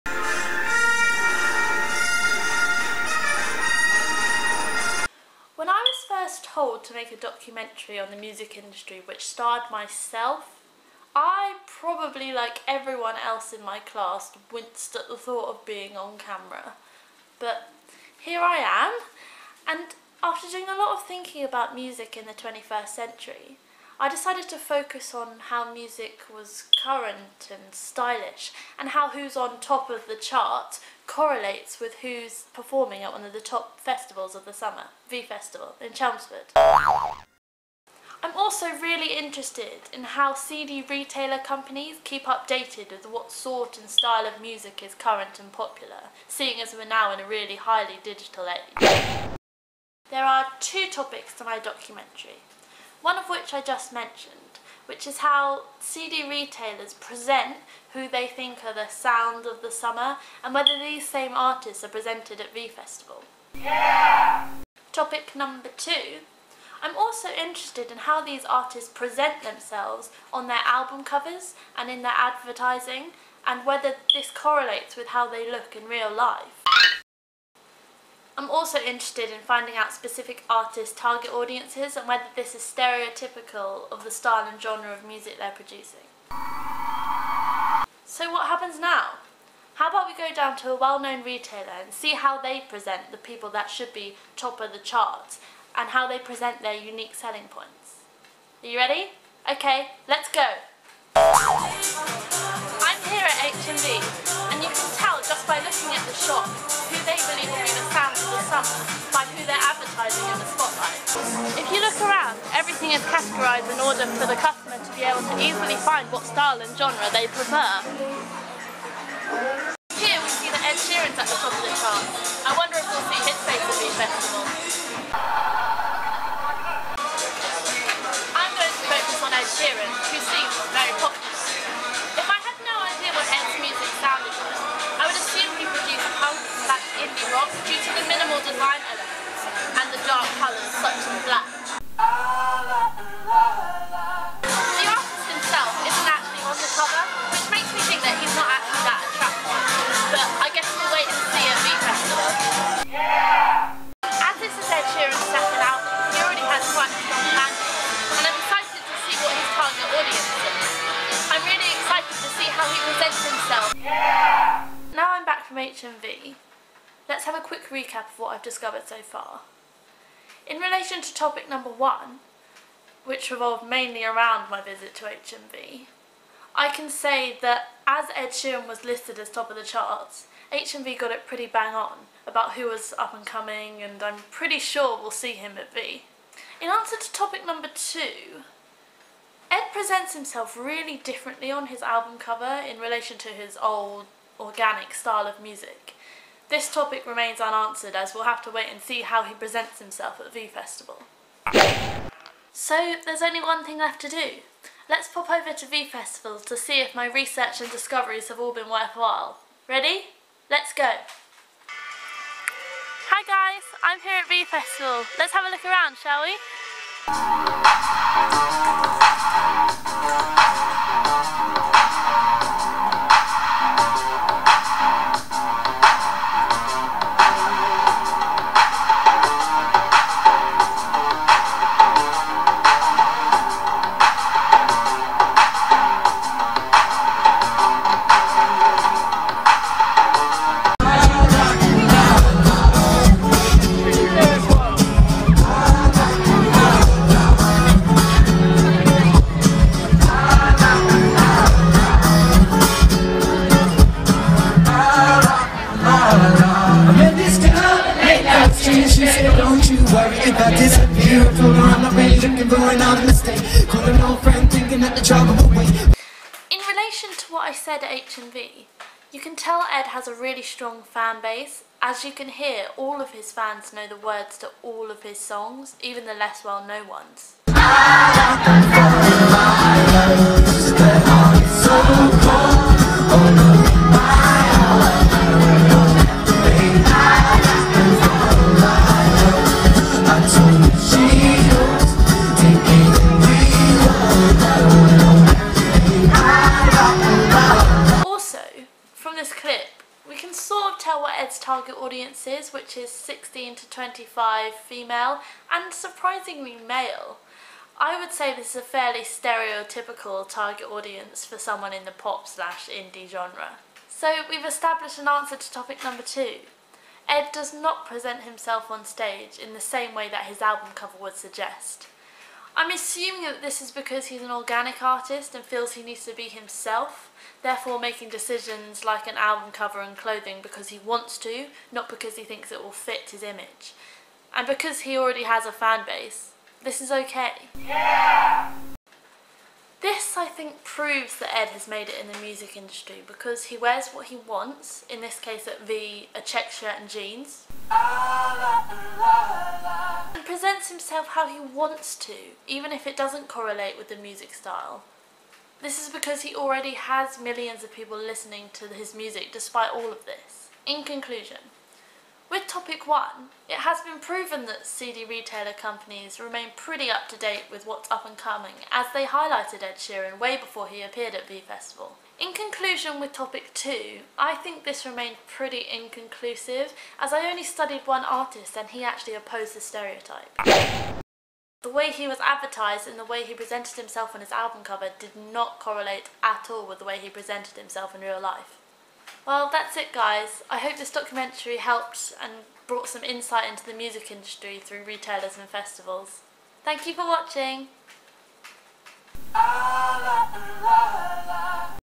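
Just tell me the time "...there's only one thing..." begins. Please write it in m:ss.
3:23.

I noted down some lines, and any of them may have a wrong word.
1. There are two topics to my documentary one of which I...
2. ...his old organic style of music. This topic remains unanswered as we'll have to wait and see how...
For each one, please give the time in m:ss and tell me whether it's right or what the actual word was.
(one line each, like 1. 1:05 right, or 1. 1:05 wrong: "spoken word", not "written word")
1. 0:50 right
2. 3:13 right.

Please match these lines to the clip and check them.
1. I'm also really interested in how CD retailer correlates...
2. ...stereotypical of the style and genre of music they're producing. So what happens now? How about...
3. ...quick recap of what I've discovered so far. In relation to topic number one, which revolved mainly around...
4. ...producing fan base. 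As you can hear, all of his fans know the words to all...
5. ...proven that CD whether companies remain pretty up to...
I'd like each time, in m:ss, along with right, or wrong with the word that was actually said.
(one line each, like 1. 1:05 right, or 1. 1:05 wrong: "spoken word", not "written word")
1. 0:36 wrong: "companies", not "correlates"
2. 1:22 right
3. 2:47 right
4. 4:30 wrong: "strong", not "producing"
5. 6:03 wrong: "retailer", not "whether".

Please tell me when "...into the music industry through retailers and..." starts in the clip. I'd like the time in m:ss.
6:33.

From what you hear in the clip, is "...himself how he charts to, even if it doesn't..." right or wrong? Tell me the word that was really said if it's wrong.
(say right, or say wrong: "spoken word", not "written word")
wrong: "wants", not "charts".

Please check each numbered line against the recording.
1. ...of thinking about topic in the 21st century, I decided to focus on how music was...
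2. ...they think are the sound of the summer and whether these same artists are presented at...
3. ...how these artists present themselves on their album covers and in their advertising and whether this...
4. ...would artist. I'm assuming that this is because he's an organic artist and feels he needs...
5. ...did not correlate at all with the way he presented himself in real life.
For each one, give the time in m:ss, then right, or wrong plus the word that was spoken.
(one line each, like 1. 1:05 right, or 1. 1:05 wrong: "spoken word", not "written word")
1. 0:20 wrong: "music", not "topic"
2. 0:58 right
3. 1:07 right
4. 5:21 wrong: "suggest", not "artist"
5. 6:24 right.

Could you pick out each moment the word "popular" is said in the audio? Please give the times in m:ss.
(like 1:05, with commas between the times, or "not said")
0:45.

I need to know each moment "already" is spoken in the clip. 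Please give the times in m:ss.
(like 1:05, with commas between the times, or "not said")
5:34, 5:56.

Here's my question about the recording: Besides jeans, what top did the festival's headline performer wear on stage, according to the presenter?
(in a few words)
a check shirt.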